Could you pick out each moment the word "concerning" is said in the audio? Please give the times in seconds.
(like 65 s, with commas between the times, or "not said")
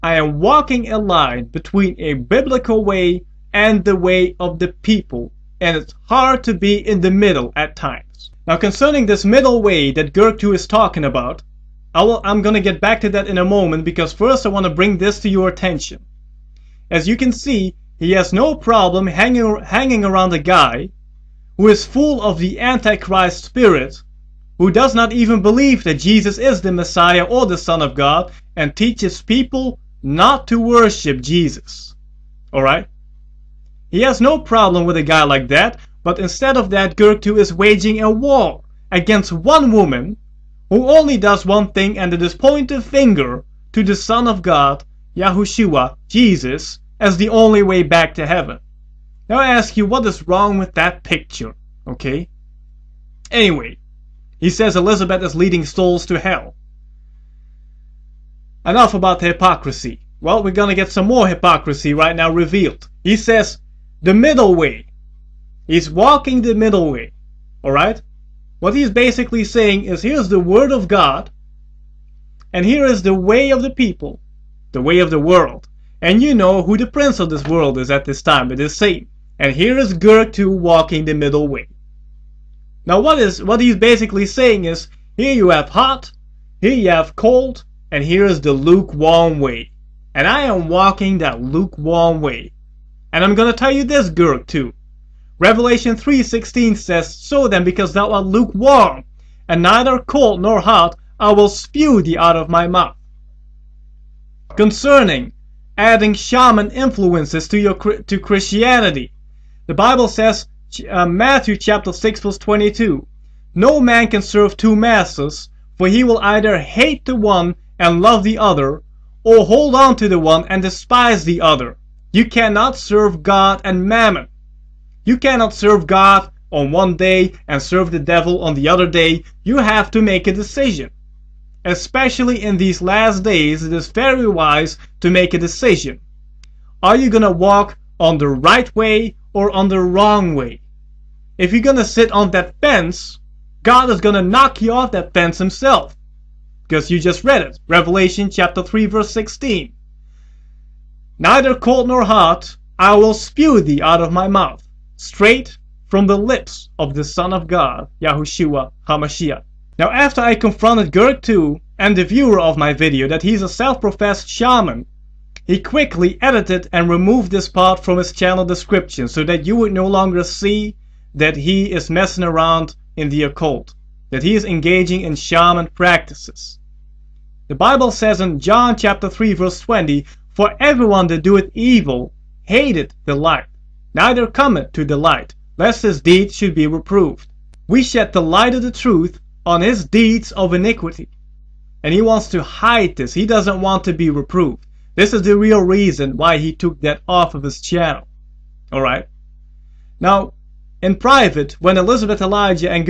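8 s, 104 s.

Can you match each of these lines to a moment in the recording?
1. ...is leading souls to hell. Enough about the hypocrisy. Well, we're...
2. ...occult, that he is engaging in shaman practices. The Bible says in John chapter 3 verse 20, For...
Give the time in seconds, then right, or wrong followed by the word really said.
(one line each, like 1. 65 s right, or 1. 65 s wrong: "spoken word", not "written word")
1. 55 s right
2. 173 s right.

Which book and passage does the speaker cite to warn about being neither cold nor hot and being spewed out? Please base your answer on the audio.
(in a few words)
Revelation 3:16.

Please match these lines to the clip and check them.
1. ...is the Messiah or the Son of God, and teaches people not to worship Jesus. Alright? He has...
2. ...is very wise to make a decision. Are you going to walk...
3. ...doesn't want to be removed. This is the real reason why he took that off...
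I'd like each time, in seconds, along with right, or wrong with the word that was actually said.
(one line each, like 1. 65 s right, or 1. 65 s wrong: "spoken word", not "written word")
1. 26 s right
2. 133 s right
3. 193 s wrong: "reproved", not "removed".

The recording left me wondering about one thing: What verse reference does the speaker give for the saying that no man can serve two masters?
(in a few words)
Matthew 6:22.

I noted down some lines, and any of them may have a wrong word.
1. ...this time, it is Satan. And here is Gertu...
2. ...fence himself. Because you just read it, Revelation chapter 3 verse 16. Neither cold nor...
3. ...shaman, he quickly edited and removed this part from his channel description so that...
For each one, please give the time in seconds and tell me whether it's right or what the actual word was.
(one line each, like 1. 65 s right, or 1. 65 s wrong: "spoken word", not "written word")
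1. 78 s right
2. 145 s right
3. 164 s right.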